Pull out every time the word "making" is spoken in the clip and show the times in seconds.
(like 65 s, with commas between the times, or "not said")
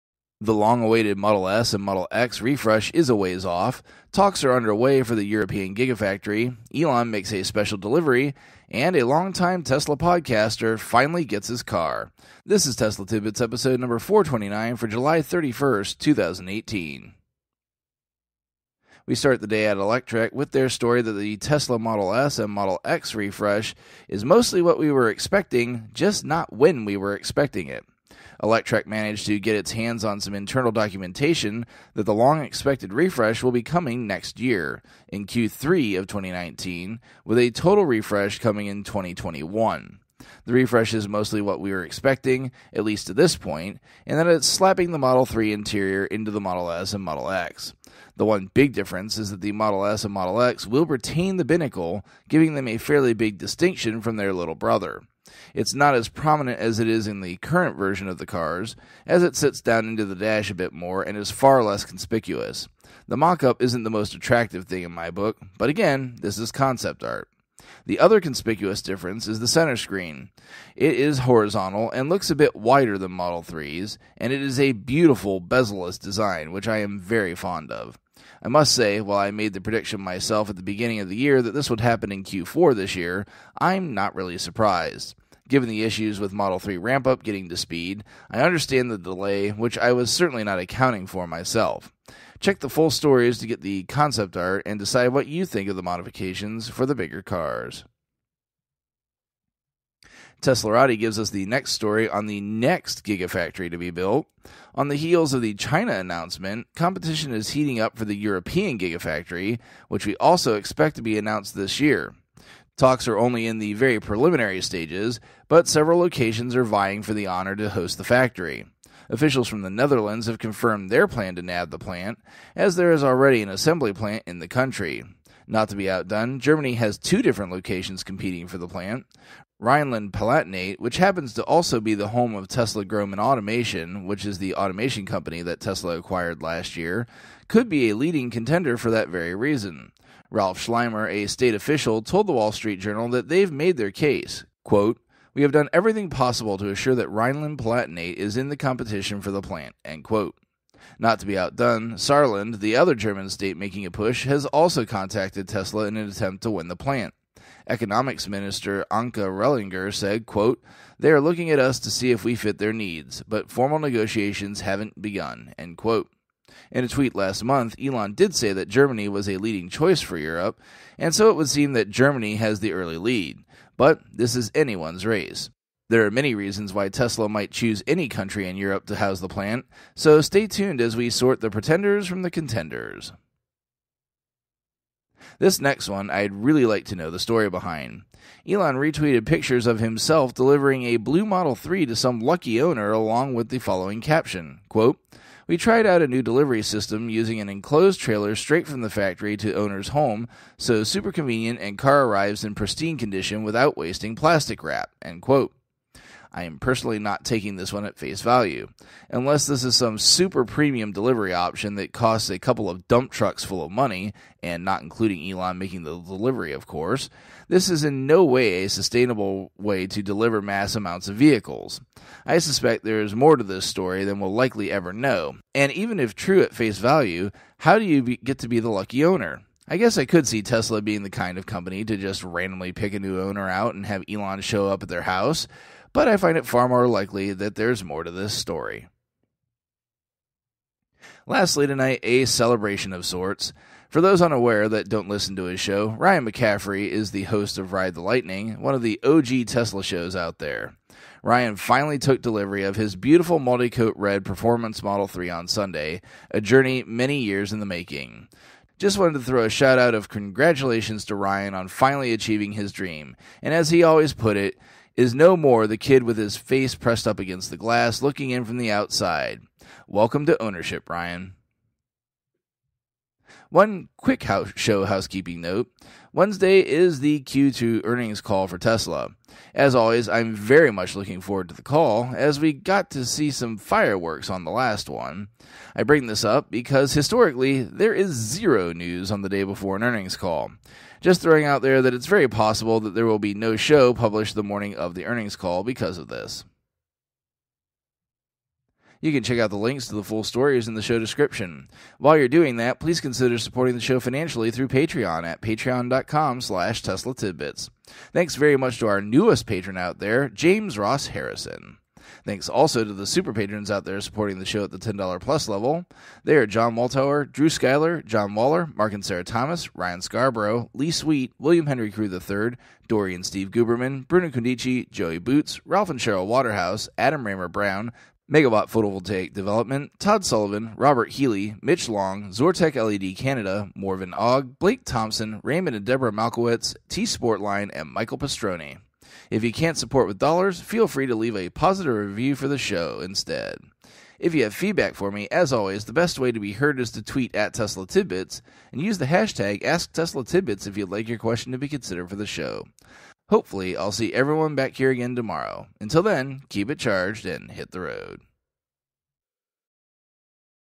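153 s, 215 s, 257 s.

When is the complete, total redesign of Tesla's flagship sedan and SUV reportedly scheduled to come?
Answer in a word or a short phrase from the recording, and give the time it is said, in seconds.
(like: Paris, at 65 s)
2021, at 38 s.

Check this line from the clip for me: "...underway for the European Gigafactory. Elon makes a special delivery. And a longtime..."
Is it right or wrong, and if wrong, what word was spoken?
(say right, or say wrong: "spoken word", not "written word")
right.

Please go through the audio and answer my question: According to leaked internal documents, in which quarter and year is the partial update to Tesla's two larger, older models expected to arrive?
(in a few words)
Q3 of 2019.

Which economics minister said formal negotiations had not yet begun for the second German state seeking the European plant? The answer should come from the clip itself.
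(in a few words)
Anke Rehlinger.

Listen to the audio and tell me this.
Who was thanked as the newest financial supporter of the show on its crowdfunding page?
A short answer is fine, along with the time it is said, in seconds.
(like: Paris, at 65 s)
James Ross Harrison, at 310 s.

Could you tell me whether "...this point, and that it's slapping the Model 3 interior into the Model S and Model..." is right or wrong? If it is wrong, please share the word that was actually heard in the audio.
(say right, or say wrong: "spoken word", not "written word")
right.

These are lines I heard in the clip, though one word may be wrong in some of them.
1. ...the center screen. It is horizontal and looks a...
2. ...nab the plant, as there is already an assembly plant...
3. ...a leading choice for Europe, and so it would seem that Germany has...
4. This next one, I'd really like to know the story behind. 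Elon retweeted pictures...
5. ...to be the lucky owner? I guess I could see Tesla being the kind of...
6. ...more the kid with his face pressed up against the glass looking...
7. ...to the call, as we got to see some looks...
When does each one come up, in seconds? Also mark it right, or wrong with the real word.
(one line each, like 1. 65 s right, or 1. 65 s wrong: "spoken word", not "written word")
1. 69 s right
2. 121 s right
3. 169 s right
4. 185 s right
5. 228 s right
6. 265 s right
7. 281 s wrong: "fireworks", not "looks".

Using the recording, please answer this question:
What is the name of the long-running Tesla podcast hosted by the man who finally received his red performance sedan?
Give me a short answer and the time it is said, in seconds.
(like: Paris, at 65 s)
Ride the Lightning, at 247 s.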